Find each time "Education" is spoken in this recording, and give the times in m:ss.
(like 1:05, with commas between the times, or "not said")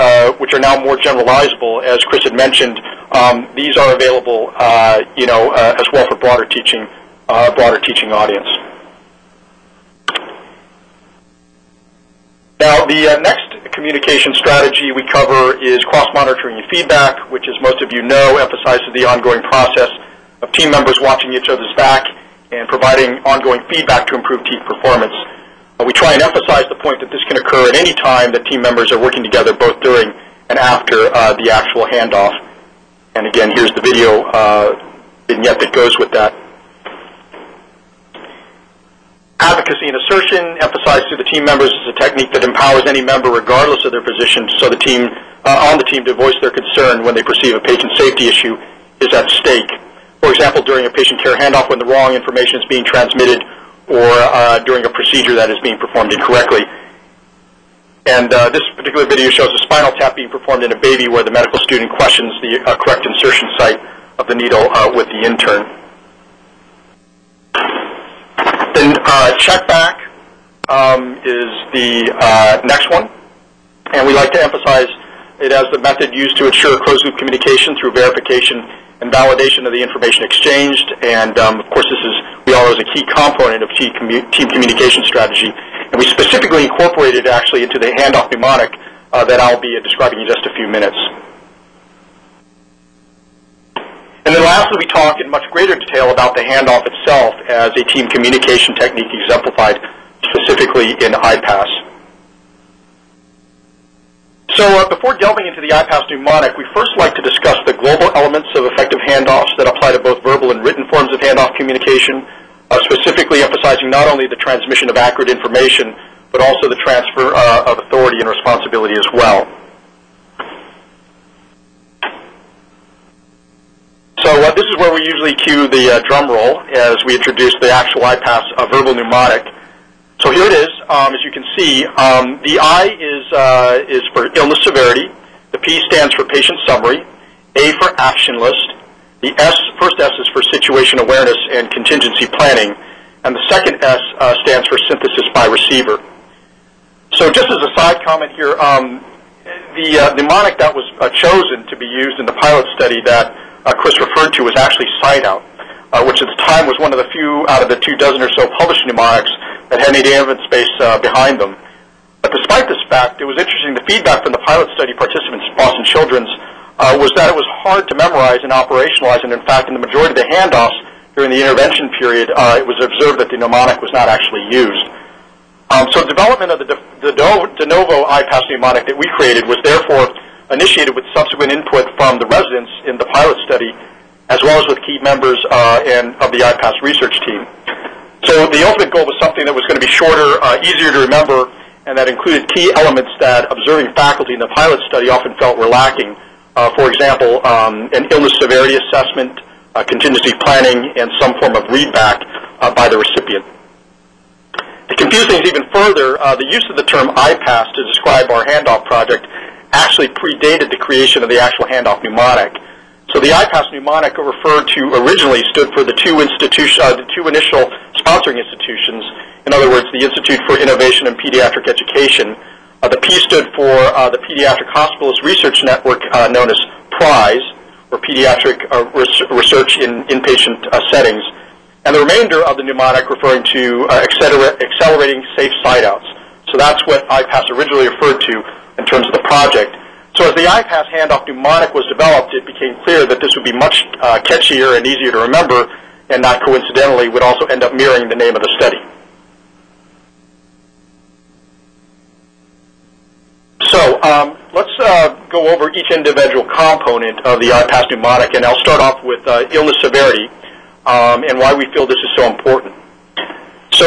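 3:41.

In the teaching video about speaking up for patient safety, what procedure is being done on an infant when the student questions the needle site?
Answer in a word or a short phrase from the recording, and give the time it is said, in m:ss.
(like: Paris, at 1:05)
spinal tap, at 0:59.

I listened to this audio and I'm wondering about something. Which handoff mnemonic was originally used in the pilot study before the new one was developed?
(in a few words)
SIGNOUT.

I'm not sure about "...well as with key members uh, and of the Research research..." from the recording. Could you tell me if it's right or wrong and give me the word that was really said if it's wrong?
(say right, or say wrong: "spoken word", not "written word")
wrong: "IPASS", not "Research".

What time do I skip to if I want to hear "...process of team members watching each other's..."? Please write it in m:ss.
0:19.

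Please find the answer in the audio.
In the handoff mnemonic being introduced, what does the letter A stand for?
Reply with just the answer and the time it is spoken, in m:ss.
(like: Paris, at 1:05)
action list, at 2:17.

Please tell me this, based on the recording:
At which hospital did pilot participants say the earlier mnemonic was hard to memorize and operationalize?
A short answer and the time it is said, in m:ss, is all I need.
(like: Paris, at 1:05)
Boston Children's, at 2:45.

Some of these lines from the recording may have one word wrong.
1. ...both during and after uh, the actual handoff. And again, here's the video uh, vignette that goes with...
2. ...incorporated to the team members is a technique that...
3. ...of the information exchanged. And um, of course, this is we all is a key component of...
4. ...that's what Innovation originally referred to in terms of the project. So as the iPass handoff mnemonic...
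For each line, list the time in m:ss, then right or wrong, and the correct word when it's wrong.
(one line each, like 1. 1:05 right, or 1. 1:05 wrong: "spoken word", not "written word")
1. 0:29 right
2. 0:40 wrong: "emphasized", not "incorporated"
3. 1:19 right
4. 3:56 wrong: "IPASS", not "Innovation".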